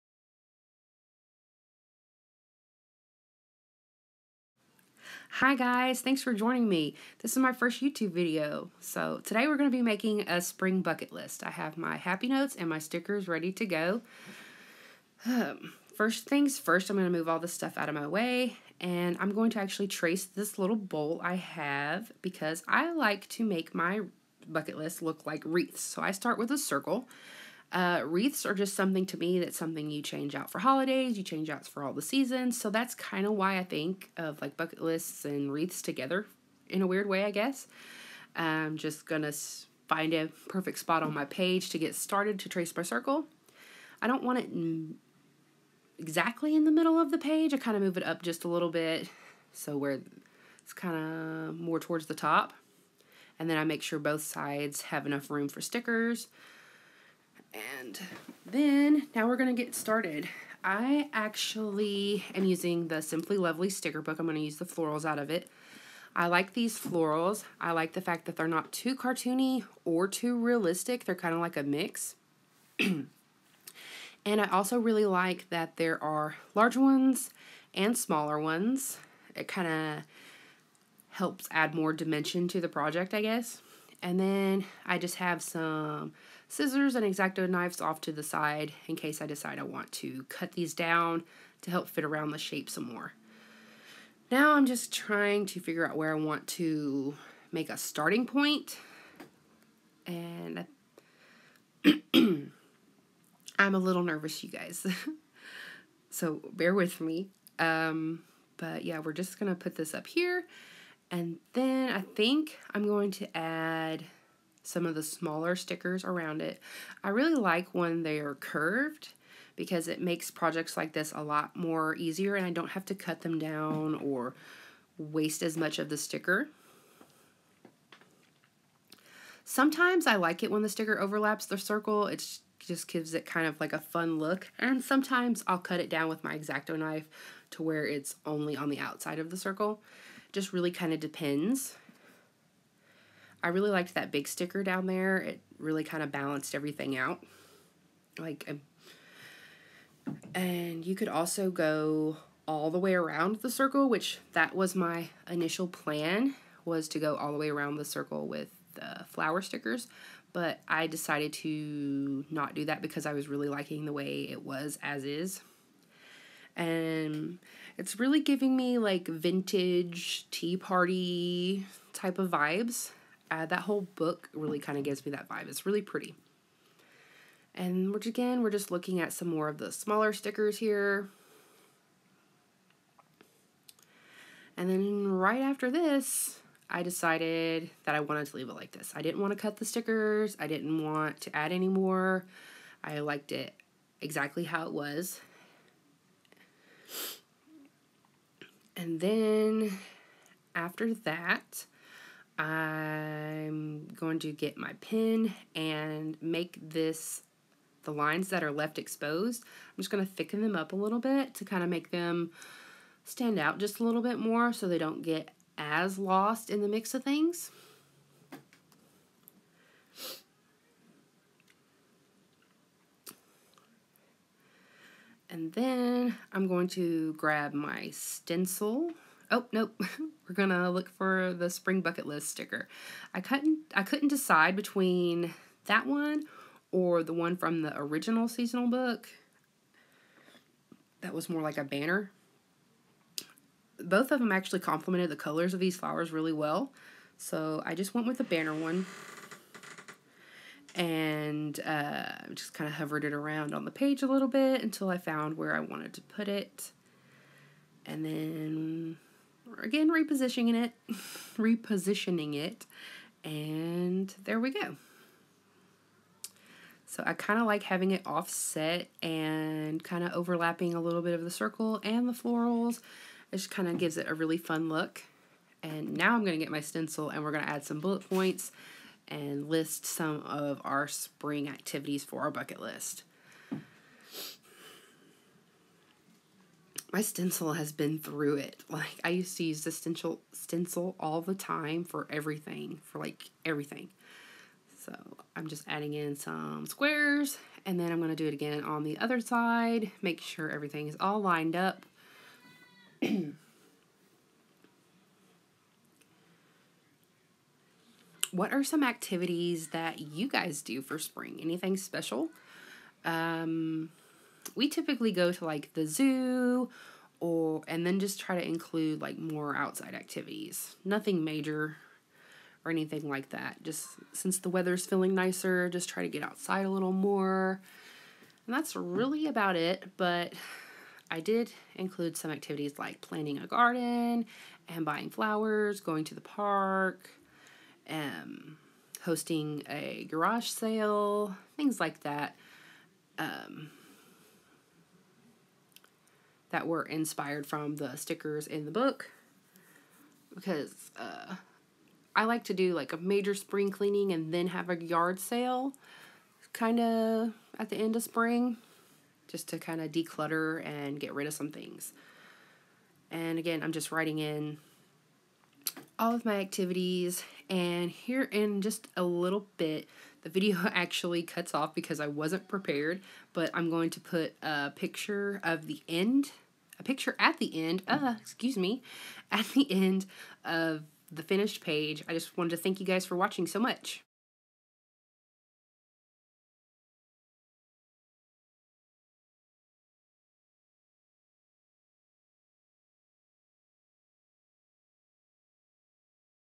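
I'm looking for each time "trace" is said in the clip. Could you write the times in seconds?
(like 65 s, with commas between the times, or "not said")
19 s, 42 s.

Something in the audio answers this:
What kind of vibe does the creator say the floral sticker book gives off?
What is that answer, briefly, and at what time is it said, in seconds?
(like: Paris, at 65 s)
Vintage tea party, at 169 s.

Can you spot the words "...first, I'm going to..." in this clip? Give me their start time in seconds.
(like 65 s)
16 s.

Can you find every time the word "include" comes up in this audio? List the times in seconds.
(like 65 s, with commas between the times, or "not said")
318 s, 331 s.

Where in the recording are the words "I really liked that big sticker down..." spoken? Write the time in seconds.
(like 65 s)
143 s.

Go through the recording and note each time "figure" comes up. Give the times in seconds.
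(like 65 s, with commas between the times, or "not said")
95 s.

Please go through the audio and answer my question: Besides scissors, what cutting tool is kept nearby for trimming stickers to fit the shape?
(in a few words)
Exacto knives.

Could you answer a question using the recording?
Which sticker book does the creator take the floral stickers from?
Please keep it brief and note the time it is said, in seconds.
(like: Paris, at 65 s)
Simply Lovely, at 63 s.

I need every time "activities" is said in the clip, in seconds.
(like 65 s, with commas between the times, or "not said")
281 s, 308 s, 319 s, 332 s, 366 s.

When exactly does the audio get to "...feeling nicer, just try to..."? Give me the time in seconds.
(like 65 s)
324 s.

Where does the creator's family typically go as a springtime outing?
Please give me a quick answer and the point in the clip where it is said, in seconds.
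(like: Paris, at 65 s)
The zoo, at 315 s.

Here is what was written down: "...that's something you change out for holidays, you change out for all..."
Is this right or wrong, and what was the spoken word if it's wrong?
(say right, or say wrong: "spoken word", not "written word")
right.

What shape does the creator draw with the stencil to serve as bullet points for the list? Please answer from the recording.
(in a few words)
Squares.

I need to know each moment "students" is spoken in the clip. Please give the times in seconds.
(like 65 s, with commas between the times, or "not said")
not said.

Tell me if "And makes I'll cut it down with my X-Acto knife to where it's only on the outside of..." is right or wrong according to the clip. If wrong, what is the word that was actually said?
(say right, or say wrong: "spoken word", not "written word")
wrong: "sometimes", not "makes".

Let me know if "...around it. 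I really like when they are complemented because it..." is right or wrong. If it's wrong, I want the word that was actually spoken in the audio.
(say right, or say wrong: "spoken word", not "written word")
wrong: "curved", not "complemented".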